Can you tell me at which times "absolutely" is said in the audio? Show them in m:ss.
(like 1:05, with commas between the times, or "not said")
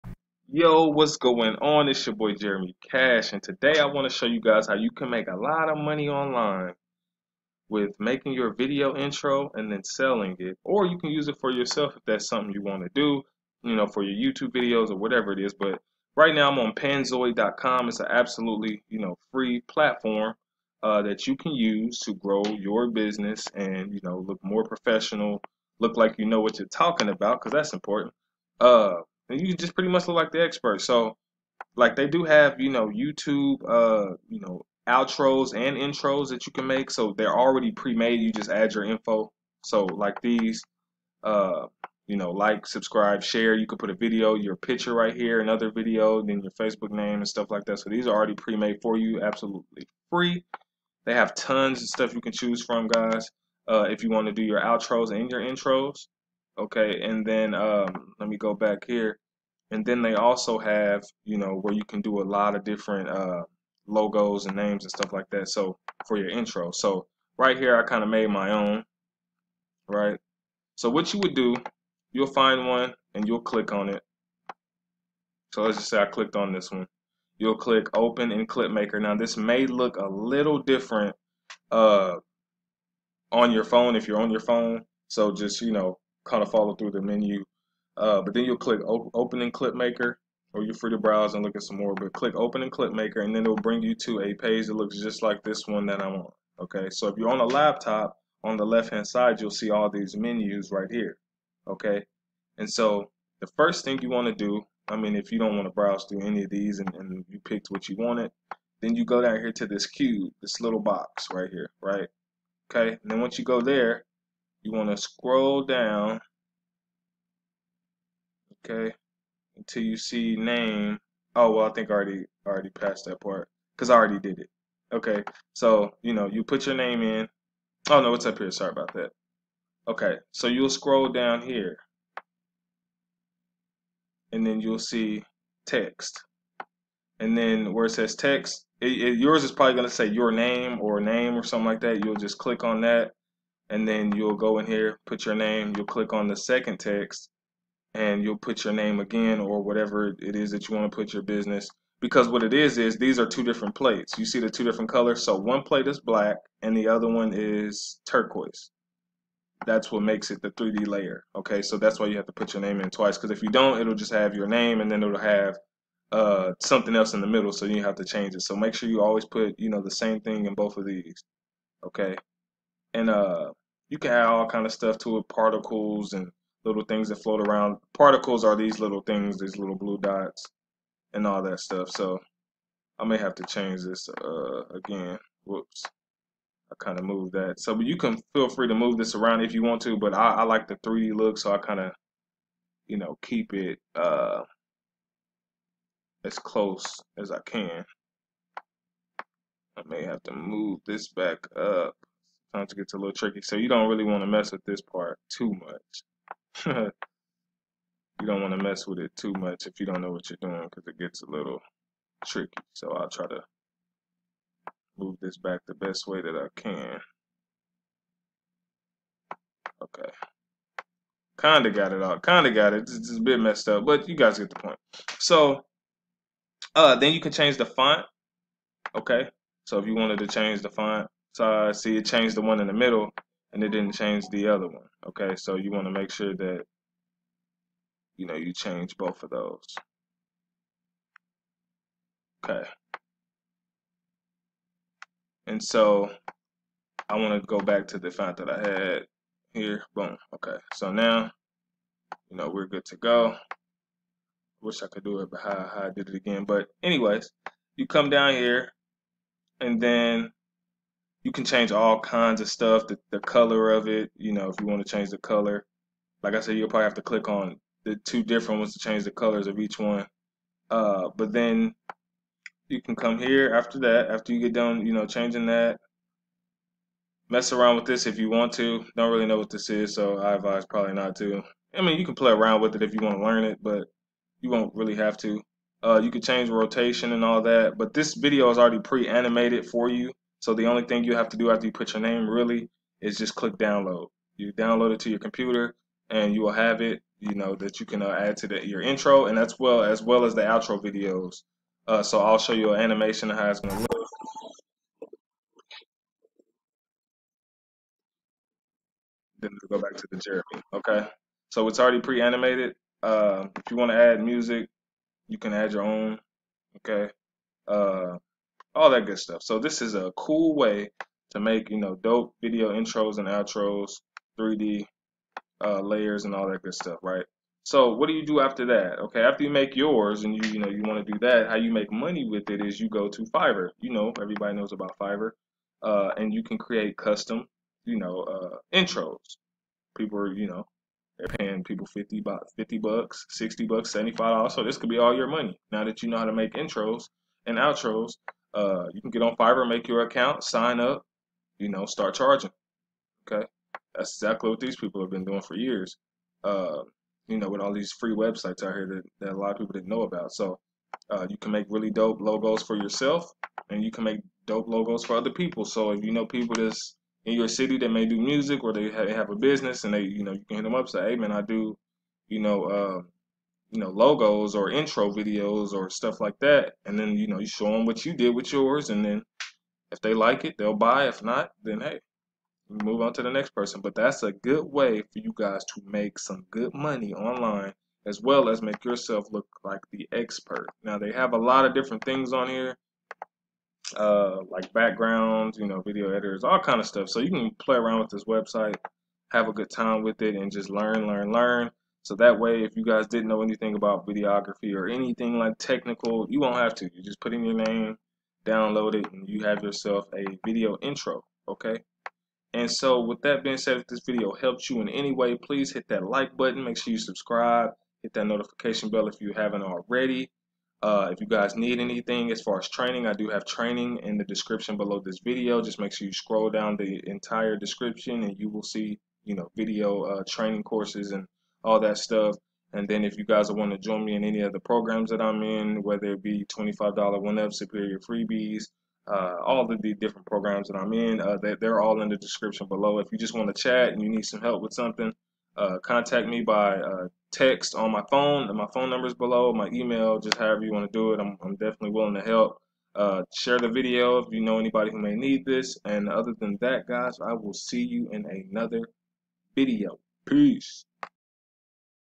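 0:18, 0:49.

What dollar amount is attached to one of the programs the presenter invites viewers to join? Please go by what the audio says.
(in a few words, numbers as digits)
$25.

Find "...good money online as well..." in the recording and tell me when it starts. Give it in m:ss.
6:26.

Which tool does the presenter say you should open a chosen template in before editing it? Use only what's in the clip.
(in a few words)
ClipMaker.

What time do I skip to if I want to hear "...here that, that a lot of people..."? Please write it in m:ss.
5:58.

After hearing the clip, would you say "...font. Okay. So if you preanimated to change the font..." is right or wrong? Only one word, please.
wrong.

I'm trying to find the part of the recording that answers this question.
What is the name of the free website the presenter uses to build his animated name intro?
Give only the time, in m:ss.
0:16.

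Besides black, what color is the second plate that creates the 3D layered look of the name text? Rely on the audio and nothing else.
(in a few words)
Turquoise.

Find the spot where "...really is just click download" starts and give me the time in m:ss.
4:52.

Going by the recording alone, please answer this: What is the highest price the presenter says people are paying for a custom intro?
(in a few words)
75 dollars.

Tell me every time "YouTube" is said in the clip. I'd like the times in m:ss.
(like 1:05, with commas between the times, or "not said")
0:14, 0:32.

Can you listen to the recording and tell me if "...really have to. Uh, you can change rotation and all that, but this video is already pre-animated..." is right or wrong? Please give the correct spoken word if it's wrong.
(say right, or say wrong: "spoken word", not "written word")
right.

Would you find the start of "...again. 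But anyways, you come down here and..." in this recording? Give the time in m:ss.
4:16.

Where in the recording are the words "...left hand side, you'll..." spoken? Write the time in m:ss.
1:38.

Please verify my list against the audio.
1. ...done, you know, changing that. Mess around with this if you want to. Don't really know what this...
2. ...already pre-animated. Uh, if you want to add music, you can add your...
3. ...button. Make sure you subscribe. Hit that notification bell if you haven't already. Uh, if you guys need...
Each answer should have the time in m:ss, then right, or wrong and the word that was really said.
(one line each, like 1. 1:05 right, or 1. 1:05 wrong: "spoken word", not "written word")
1. 4:34 right
2. 5:11 right
3. 6:56 right.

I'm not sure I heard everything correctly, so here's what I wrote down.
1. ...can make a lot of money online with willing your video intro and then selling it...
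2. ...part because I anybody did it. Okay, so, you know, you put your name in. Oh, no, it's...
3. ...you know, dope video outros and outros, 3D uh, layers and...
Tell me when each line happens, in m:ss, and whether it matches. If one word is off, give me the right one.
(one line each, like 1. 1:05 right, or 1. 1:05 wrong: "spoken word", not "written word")
1. 0:04 wrong: "making", not "willing"
2. 2:03 wrong: "already", not "anybody"
3. 5:21 wrong: "intros", not "outros".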